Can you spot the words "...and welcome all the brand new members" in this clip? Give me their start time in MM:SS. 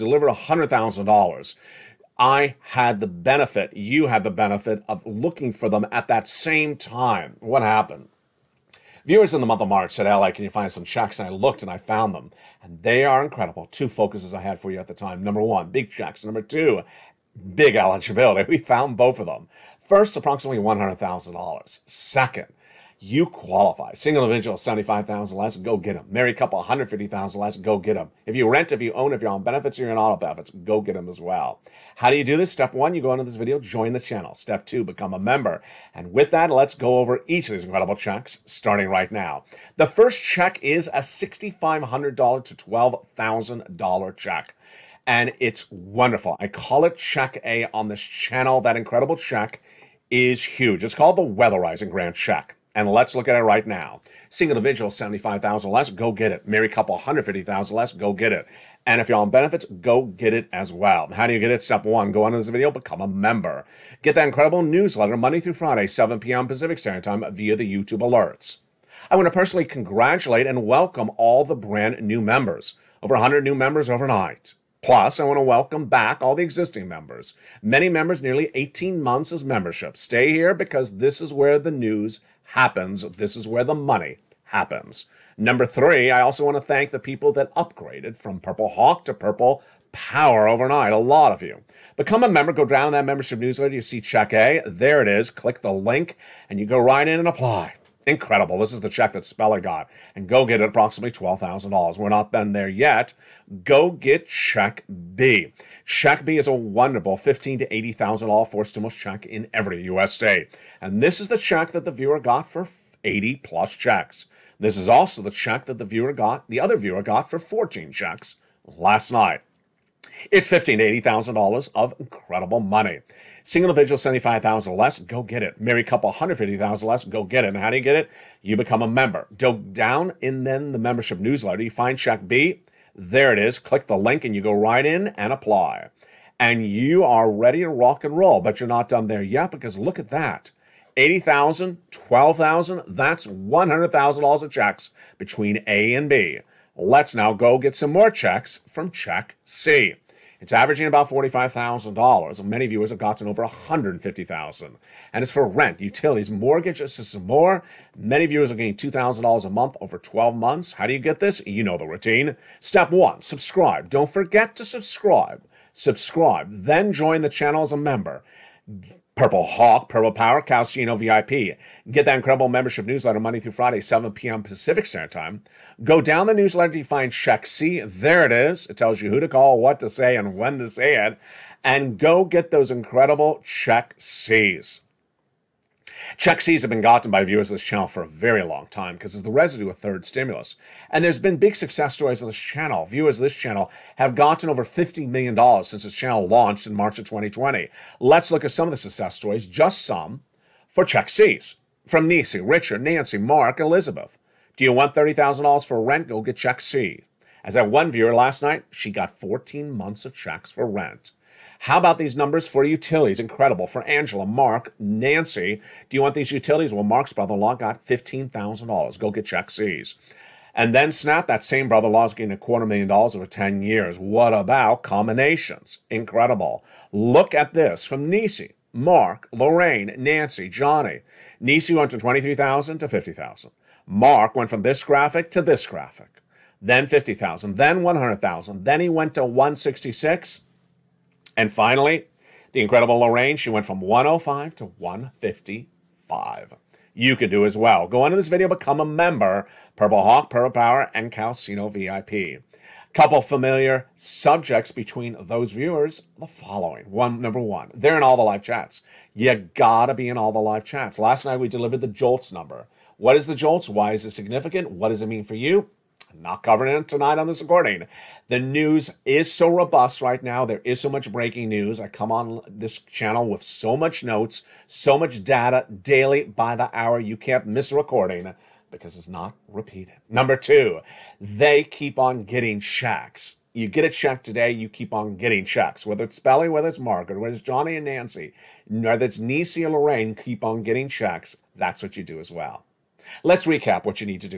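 01:10.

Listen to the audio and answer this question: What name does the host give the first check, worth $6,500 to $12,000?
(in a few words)
Weatherizing Grand Shack.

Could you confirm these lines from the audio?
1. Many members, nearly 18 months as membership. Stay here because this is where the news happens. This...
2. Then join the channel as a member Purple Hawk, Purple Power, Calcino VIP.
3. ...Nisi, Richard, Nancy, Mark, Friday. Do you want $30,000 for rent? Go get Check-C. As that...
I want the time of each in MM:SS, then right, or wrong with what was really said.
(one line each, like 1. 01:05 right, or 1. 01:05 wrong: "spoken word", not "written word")
1. 01:17 right
2. 02:46 right
3. 03:22 wrong: "Elizabeth", not "Friday".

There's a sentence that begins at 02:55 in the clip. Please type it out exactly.
Go down the newsletter to find Check C.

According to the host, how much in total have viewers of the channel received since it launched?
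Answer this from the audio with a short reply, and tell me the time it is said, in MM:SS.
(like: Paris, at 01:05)
$50 million, at 03:14.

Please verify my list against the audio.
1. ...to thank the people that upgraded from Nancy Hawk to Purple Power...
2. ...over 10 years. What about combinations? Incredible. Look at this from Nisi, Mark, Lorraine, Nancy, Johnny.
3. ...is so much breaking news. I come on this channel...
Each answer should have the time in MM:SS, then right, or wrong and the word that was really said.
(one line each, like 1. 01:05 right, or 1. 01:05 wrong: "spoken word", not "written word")
1. 01:26 wrong: "Purple", not "Nancy"
2. 03:43 right
3. 04:30 right.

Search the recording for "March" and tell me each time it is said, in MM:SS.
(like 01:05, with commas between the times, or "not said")
00:09, 03:16.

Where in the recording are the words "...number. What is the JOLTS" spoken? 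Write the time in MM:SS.
04:22.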